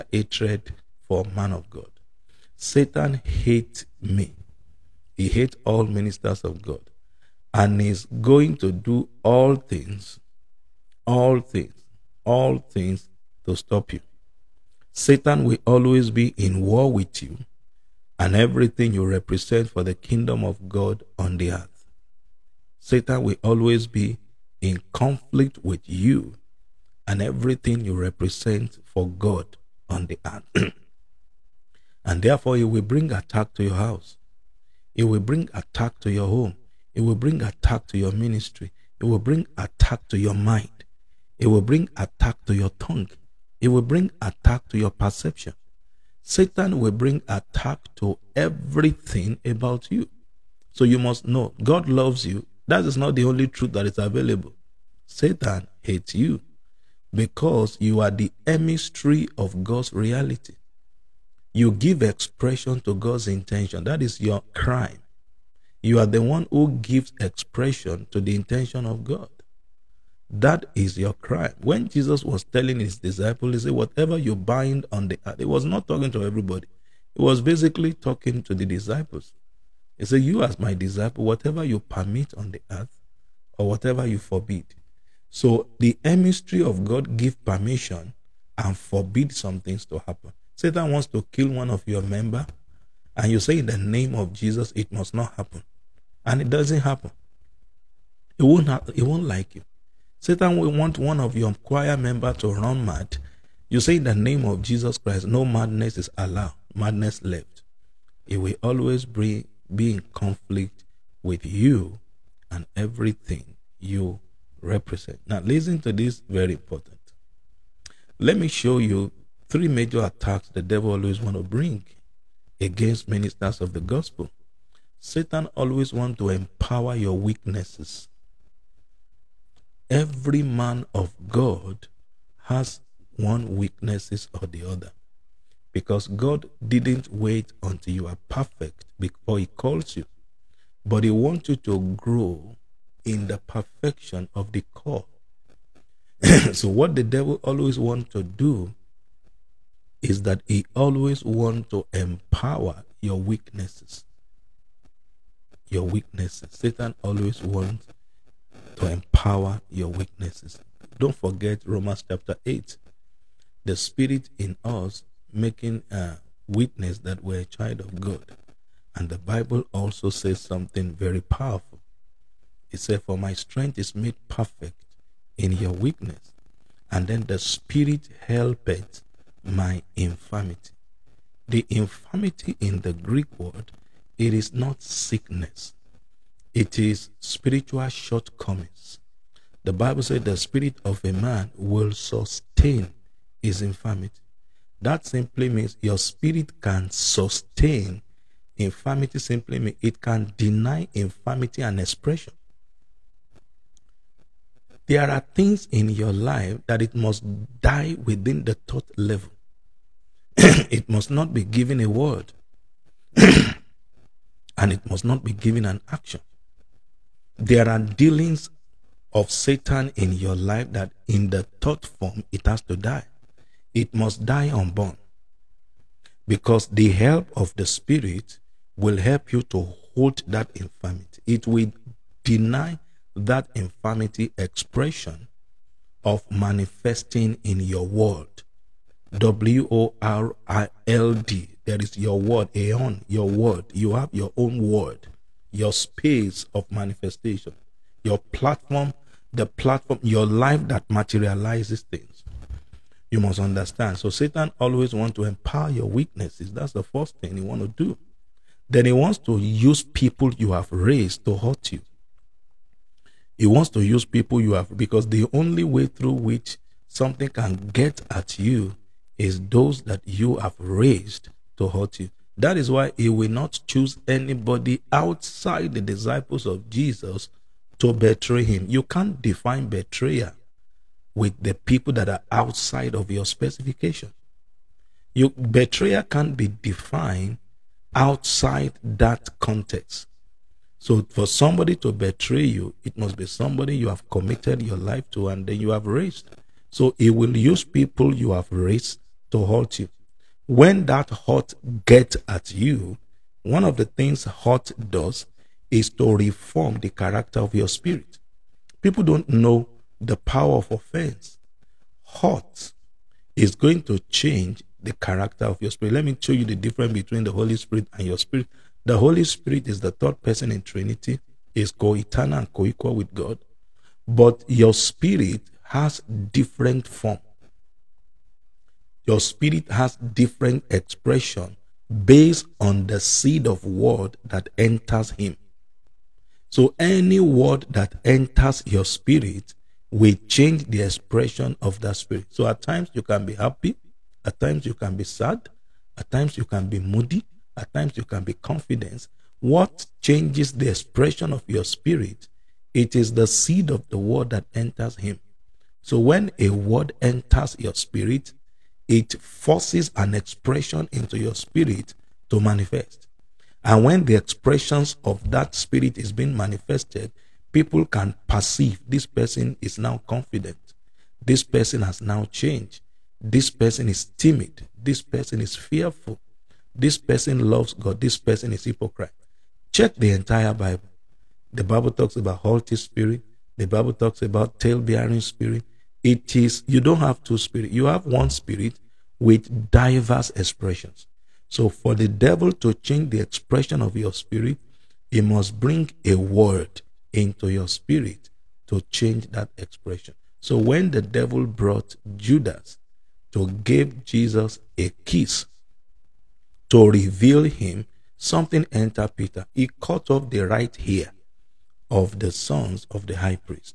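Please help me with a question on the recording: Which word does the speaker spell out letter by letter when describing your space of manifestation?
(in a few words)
world.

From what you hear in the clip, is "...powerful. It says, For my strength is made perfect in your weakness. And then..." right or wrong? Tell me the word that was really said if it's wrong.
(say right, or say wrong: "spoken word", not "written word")
right.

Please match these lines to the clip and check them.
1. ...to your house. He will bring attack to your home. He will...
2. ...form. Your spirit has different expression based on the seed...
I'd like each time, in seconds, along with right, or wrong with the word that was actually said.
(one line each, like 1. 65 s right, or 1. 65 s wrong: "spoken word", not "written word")
1. 33 s right
2. 326 s right.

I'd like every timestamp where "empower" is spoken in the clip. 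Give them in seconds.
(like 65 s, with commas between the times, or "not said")
126 s, 151 s, 158 s, 255 s.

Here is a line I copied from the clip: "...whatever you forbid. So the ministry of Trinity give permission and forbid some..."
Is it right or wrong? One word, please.
wrong.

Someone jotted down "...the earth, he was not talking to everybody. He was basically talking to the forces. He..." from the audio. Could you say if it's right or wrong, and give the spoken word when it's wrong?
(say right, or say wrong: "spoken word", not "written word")
wrong: "disciples", not "forces".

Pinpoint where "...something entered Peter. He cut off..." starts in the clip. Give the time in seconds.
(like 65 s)
408 s.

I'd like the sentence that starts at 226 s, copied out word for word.
Because the help of the Spirit will help you to hold that infirmity.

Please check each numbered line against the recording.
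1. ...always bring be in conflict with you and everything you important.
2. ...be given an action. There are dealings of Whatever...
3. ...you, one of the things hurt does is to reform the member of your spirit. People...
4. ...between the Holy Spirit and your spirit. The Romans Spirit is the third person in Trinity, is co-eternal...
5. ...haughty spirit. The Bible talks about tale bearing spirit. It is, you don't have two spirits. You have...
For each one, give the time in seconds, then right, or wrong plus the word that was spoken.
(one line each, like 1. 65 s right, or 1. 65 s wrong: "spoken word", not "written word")
1. 108 s wrong: "represent", not "important"
2. 215 s wrong: "Satan", not "Whatever"
3. 302 s wrong: "character", not "member"
4. 316 s wrong: "Holy", not "Romans"
5. 382 s right.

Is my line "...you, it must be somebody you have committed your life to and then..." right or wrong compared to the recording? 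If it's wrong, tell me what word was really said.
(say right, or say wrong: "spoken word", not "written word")
right.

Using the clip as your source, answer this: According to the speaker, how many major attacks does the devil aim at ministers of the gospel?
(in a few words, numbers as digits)
3.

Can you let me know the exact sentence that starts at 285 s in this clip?
You, betrayal can't be defined outside that context.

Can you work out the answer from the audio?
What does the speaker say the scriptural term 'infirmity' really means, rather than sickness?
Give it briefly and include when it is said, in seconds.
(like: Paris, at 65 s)
spiritual shortcomings, at 187 s.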